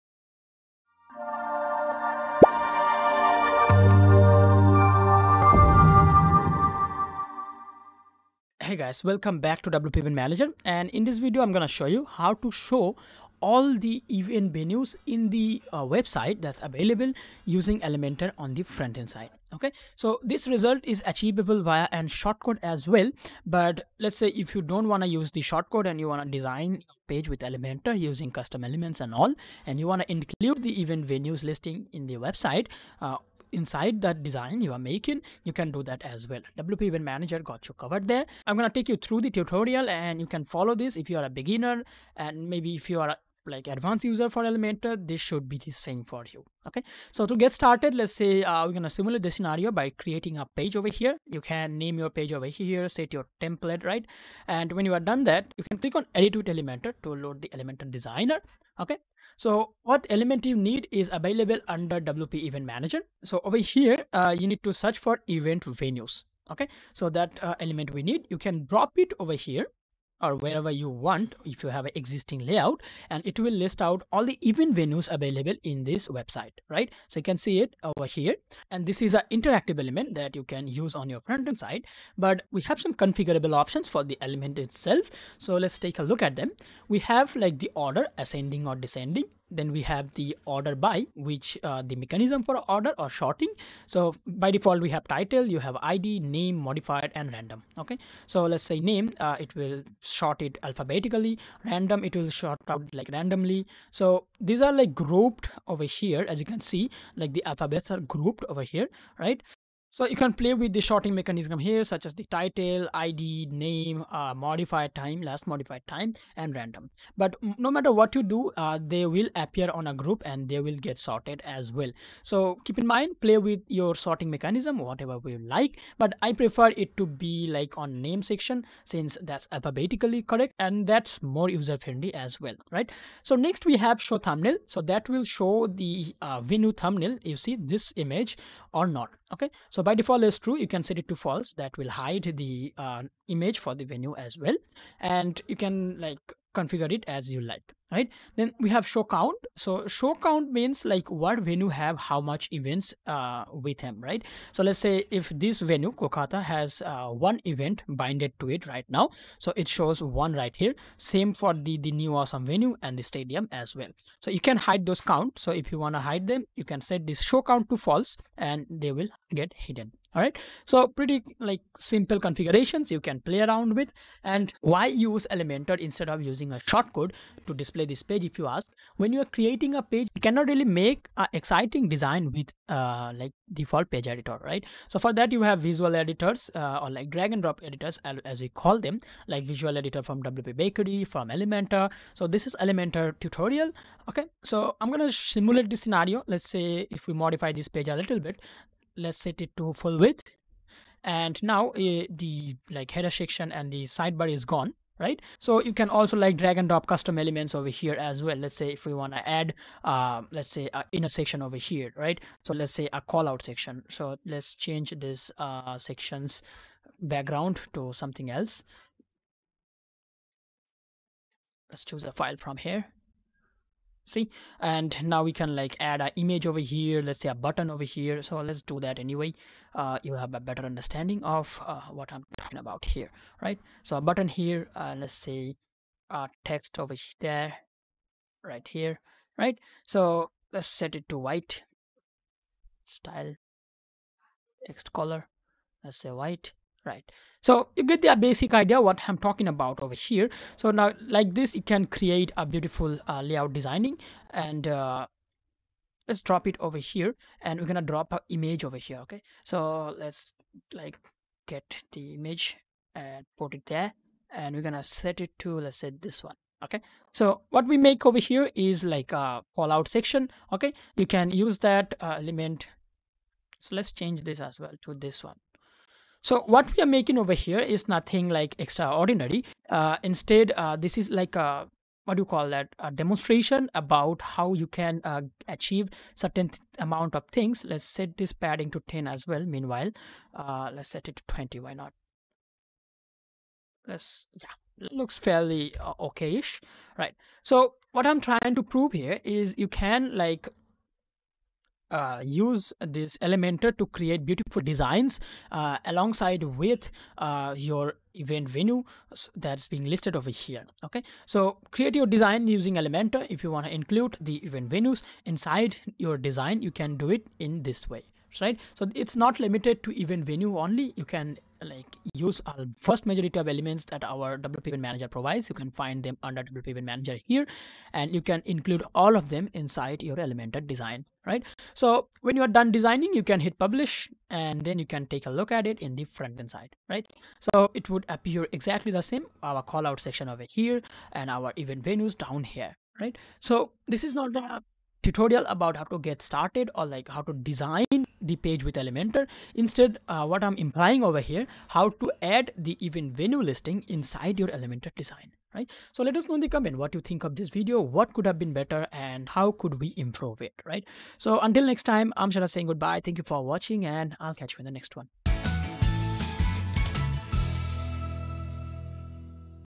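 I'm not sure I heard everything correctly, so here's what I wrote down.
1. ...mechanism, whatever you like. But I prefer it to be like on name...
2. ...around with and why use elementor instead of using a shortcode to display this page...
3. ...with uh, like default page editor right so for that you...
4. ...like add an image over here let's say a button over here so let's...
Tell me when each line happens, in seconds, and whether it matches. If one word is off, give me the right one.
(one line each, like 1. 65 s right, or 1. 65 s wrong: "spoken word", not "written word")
1. 124 s right
2. 173 s right
3. 182 s right
4. 225 s right.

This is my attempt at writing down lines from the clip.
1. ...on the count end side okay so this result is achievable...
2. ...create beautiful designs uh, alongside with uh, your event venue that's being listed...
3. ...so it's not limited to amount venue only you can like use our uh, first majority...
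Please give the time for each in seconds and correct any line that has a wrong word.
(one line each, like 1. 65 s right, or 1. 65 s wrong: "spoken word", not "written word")
1. 18 s wrong: "front", not "count"
2. 303 s right
3. 318 s wrong: "event", not "amount".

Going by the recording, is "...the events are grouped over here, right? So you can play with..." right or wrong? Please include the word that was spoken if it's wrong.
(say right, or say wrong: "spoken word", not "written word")
wrong: "alphabets", not "events".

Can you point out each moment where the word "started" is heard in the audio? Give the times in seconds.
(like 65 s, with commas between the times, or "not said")
47 s, 346 s.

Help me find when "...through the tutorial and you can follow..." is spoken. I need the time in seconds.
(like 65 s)
38 s.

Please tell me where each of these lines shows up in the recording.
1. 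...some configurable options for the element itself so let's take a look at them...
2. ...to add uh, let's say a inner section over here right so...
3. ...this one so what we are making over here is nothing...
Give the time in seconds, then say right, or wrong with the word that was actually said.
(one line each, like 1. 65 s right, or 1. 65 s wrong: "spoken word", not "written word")
1. 82 s right
2. 209 s right
3. 274 s right.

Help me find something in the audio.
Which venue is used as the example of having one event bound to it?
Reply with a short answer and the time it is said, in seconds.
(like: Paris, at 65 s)
Kolkata, at 155 s.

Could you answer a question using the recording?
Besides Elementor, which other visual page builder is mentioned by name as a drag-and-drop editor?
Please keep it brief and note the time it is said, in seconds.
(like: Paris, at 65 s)
WP Bakery, at 190 s.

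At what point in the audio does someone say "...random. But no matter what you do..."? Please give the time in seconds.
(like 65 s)
116 s.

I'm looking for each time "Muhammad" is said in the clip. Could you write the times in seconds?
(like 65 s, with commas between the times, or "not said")
not said.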